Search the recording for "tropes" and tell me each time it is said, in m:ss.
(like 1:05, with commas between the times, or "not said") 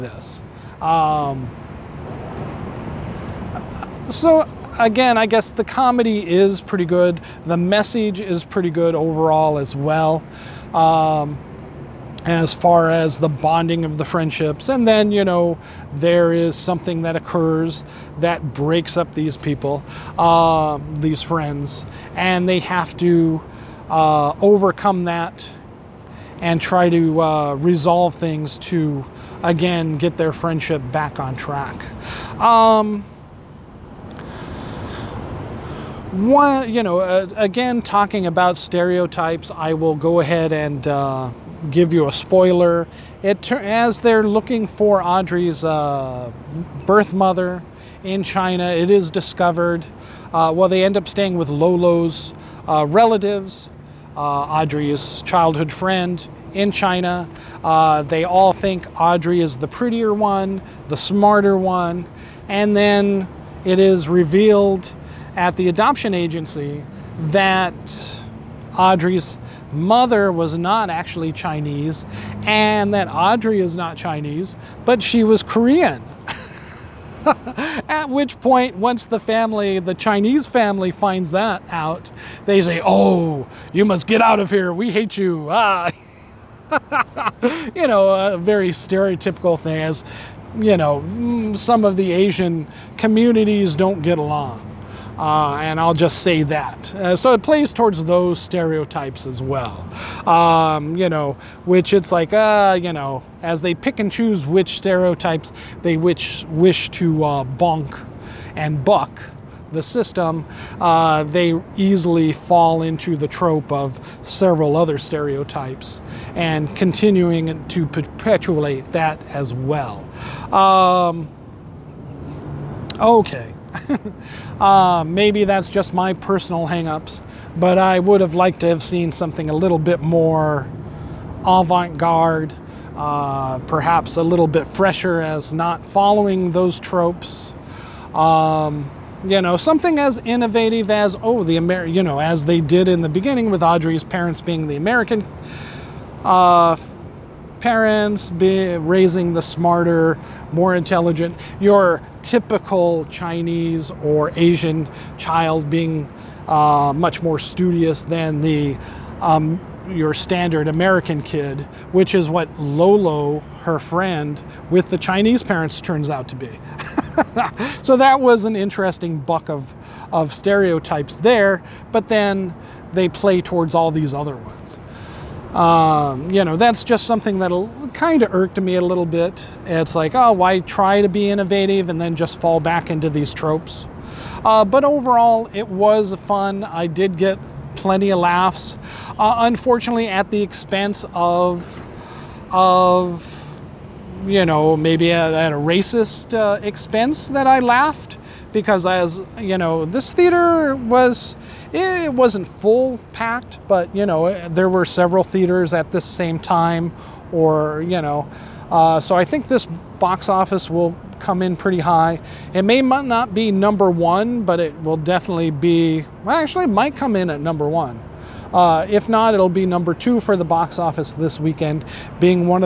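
1:53, 2:16, 3:03.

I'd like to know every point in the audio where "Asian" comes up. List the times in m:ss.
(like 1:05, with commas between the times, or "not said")
1:32, 2:34.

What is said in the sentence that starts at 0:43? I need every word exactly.
It as they're looking for Audrey's uh, birth mother in China, it is discovered.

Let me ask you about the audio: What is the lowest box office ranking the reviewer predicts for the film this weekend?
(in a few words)
2.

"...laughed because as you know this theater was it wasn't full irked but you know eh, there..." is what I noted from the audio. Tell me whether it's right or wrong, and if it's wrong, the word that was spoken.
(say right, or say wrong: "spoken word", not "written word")
wrong: "packed", not "irked".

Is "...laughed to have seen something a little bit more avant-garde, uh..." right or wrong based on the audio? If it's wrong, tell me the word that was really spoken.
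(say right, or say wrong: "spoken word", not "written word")
wrong: "liked", not "laughed".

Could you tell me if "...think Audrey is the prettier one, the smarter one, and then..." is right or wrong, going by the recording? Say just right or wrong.
right.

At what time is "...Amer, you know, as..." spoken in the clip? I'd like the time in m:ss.
2:21.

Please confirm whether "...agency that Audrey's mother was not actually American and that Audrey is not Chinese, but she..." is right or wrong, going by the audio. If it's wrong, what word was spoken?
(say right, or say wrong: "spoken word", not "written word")
wrong: "Chinese", not "American".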